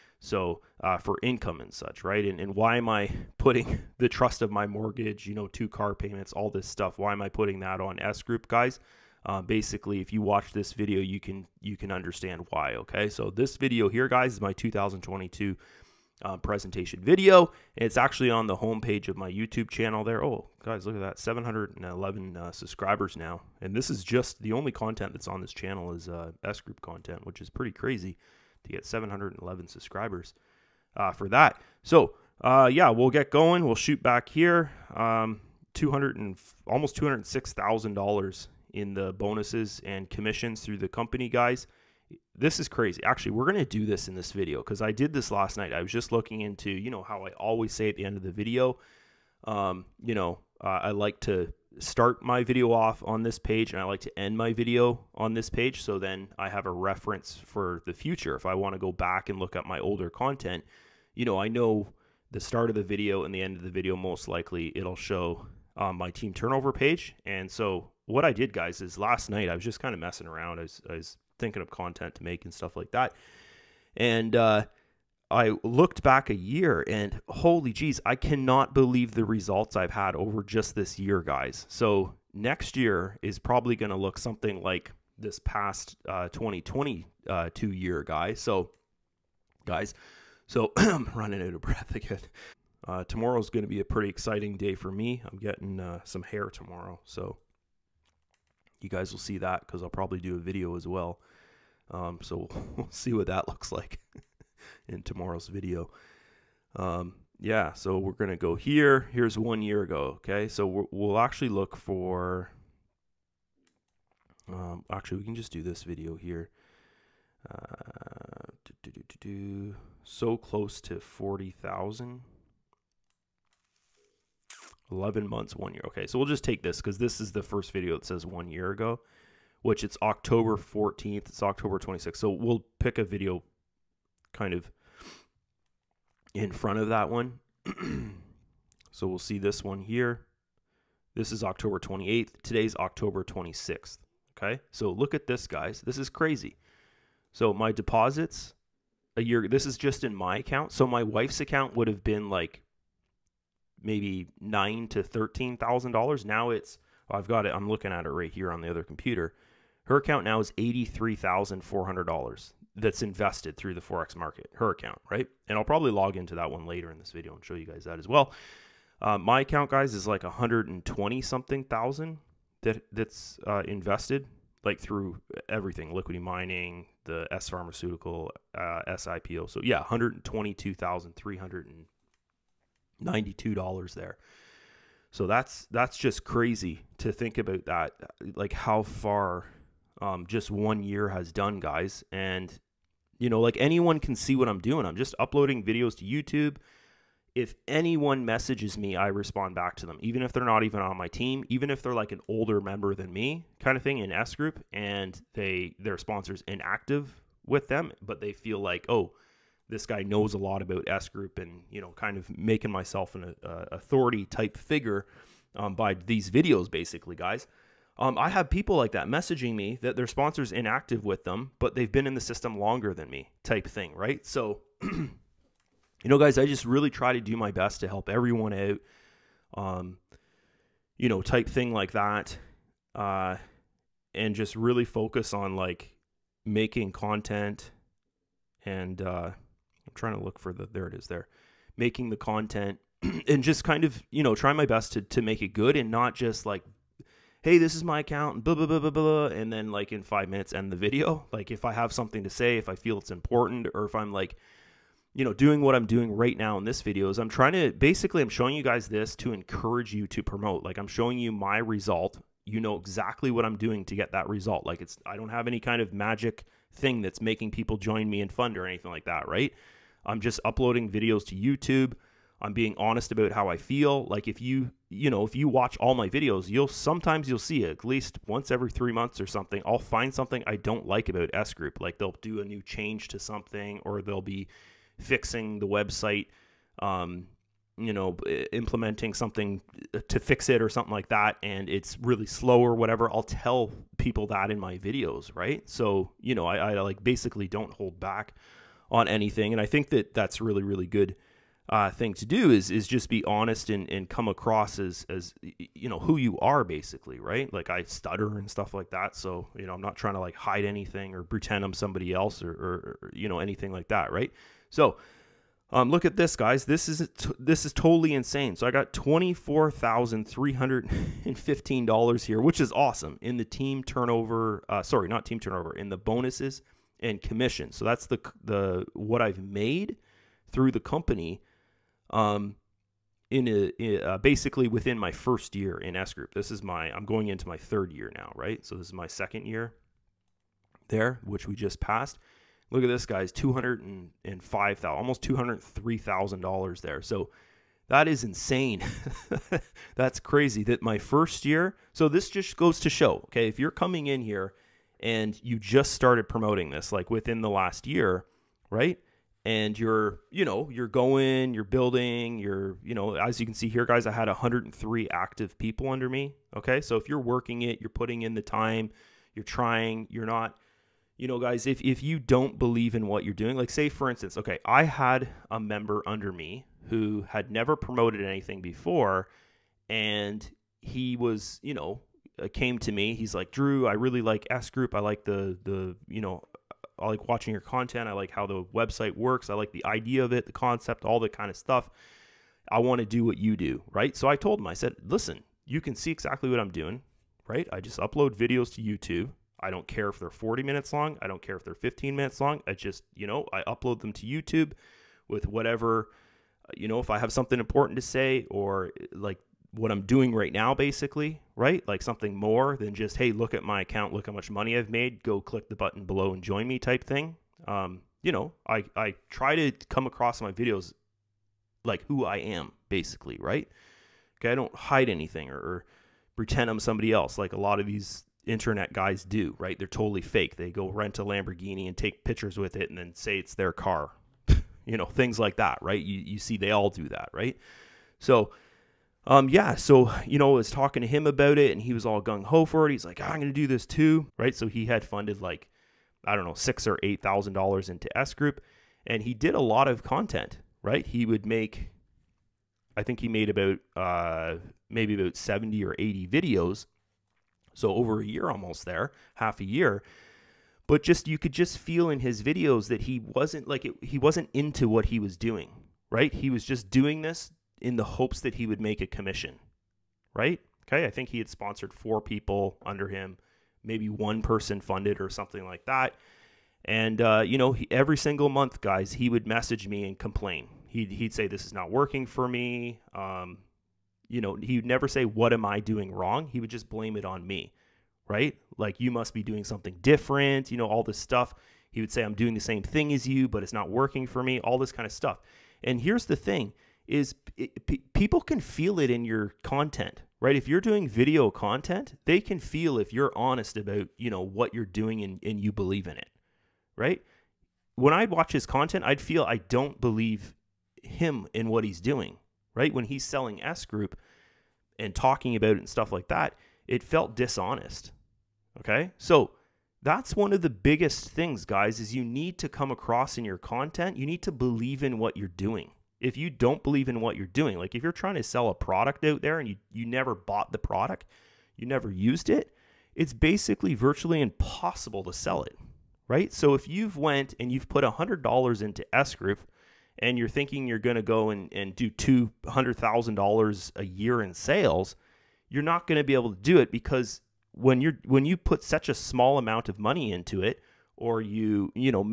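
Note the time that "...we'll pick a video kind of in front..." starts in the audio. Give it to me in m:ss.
2:12.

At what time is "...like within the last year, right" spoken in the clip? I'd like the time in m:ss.
5:56.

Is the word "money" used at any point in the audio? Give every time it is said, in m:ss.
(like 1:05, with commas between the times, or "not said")
6:54, 9:09.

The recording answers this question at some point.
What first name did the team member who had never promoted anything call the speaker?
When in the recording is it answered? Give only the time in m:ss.
6:23.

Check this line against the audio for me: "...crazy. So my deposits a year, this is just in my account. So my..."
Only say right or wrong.
right.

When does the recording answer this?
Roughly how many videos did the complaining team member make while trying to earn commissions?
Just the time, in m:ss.
7:35.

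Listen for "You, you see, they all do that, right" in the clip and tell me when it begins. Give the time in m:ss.
7:16.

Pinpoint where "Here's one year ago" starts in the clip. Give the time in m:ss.
1:49.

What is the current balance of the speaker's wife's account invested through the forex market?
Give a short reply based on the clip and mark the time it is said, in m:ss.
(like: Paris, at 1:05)
$83,400, at 2:40.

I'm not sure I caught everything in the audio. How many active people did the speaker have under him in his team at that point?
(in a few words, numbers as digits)
103.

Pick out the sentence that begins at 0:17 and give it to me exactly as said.
It's actually on the homepage of my YouTube channel there.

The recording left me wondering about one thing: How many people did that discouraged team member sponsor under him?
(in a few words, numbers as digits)
4.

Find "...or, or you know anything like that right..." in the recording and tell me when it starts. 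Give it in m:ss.
5:12.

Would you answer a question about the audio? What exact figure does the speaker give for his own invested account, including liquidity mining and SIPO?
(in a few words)
$122,392.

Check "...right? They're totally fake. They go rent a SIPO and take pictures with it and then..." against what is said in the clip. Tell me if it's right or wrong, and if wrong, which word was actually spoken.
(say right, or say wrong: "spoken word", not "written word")
wrong: "Lamborghini", not "SIPO".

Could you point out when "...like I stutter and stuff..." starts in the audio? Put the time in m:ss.
5:07.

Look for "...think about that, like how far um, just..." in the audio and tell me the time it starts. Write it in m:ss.
3:07.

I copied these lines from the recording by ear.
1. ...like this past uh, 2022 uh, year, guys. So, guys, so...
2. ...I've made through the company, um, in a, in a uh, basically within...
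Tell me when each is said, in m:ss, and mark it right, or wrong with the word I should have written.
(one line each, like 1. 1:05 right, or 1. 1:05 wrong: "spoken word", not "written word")
1. 1:24 right
2. 5:29 right.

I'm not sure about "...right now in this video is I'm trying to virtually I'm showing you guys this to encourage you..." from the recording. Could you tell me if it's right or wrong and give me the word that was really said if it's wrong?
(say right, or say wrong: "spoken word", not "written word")
wrong: "basically", not "virtually".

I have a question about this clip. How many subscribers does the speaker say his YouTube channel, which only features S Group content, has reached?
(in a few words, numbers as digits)
711.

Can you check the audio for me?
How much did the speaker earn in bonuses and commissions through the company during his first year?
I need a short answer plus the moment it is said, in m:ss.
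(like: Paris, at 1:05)
$24,315, at 5:18.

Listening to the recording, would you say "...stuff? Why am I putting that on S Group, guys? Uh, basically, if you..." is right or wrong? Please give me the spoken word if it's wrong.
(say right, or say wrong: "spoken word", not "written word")
right.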